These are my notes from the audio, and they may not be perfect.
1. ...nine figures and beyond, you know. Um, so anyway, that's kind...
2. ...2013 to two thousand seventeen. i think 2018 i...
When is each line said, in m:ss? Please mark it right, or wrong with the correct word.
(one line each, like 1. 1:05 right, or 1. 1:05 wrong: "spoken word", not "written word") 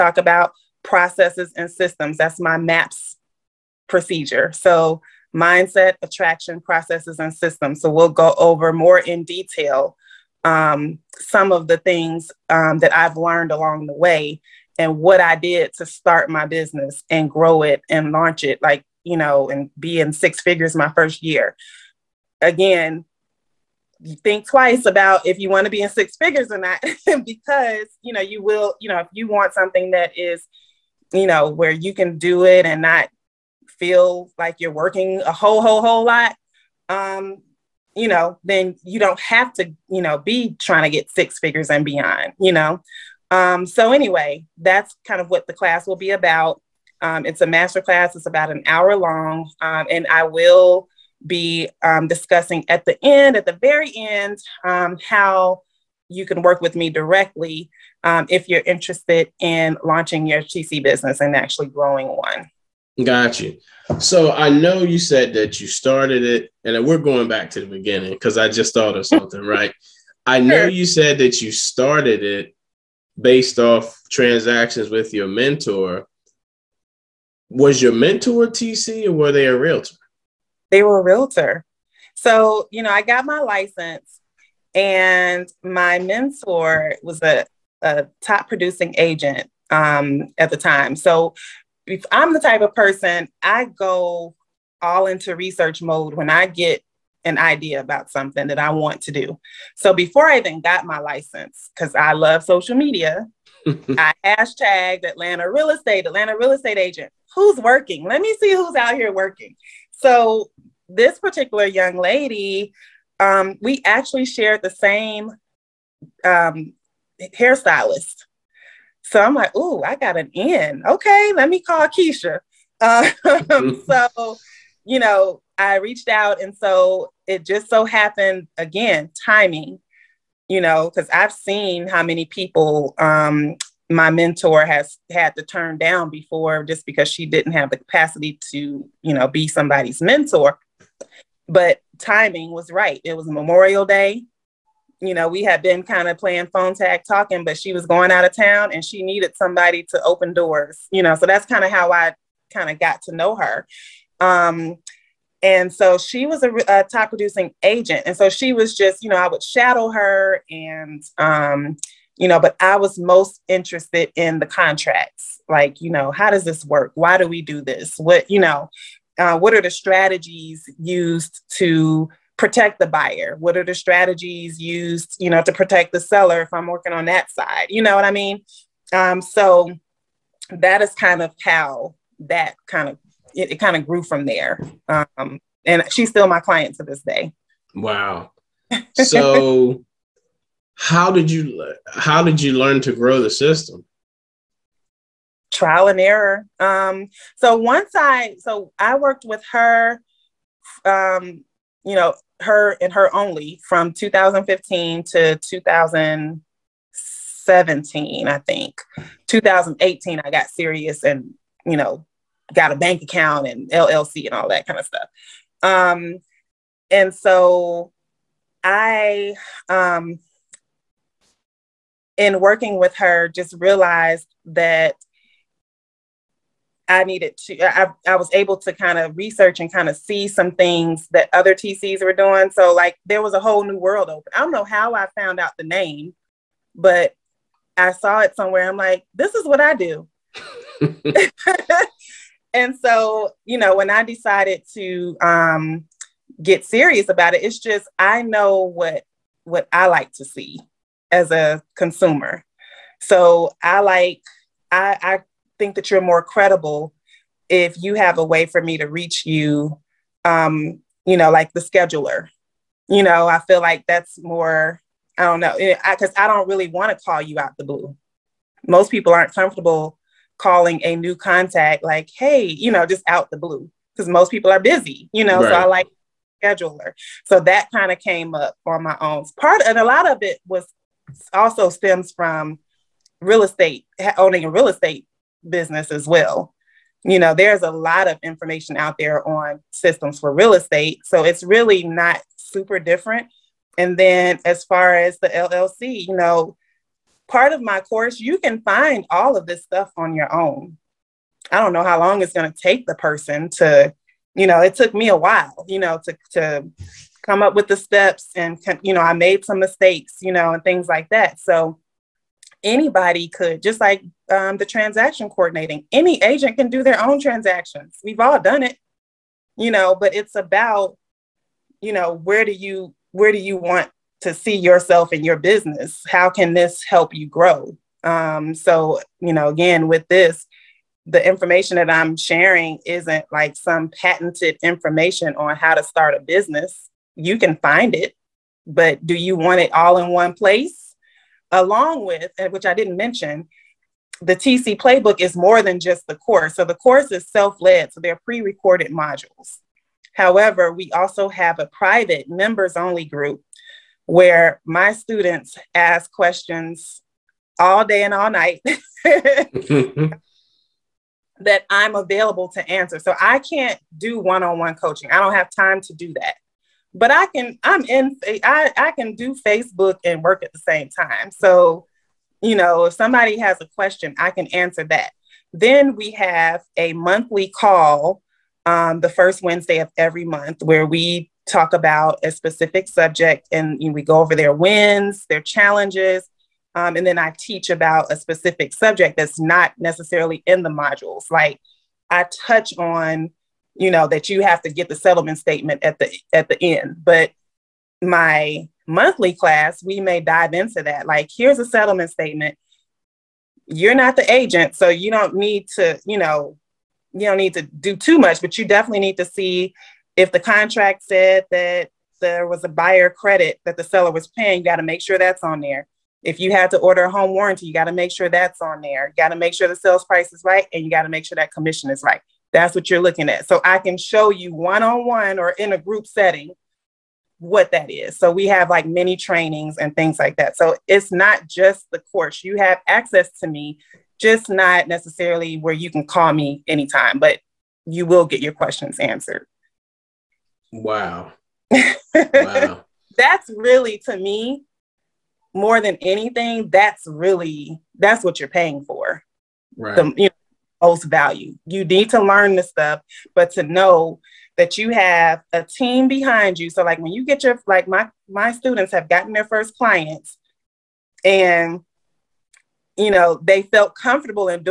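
1. 0:41 wrong: "six", not "nine"
2. 3:23 wrong: "2015", not "2013".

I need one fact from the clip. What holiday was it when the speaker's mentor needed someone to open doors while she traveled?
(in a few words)
Memorial Day.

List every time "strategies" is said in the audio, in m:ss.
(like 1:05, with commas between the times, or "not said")
2:49, 2:53.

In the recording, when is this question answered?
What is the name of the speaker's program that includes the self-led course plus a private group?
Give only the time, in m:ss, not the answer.
5:44.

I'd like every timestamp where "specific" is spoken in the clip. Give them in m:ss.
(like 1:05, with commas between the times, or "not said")
6:22, 6:28.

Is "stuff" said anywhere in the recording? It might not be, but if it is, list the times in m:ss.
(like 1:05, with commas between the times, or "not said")
3:34, 4:59, 7:32.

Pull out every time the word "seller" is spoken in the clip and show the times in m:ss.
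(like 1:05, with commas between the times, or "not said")
2:56, 6:53.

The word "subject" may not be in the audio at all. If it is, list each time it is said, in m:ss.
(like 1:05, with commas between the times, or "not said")
6:22, 6:28.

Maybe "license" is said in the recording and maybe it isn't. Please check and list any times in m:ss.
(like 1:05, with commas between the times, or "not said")
1:23, 1:40.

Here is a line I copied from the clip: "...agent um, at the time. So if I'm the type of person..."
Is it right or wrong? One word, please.
right.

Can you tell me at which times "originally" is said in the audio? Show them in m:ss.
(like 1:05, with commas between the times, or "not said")
not said.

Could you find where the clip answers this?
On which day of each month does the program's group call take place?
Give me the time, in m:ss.
6:19.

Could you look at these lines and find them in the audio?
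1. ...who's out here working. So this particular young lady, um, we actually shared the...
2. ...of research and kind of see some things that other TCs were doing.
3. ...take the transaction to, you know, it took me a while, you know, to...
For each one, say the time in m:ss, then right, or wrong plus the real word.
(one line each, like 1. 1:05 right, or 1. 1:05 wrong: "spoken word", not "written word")
1. 1:48 right
2. 3:48 right
3. 5:02 wrong: "person", not "transaction".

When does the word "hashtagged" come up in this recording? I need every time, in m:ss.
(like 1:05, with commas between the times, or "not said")
1:44.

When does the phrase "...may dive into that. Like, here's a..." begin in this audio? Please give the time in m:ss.
6:39.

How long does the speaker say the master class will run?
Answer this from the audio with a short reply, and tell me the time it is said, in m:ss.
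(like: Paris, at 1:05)
About an hour, at 0:48.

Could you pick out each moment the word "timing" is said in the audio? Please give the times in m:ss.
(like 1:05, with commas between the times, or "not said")
2:09, 2:21.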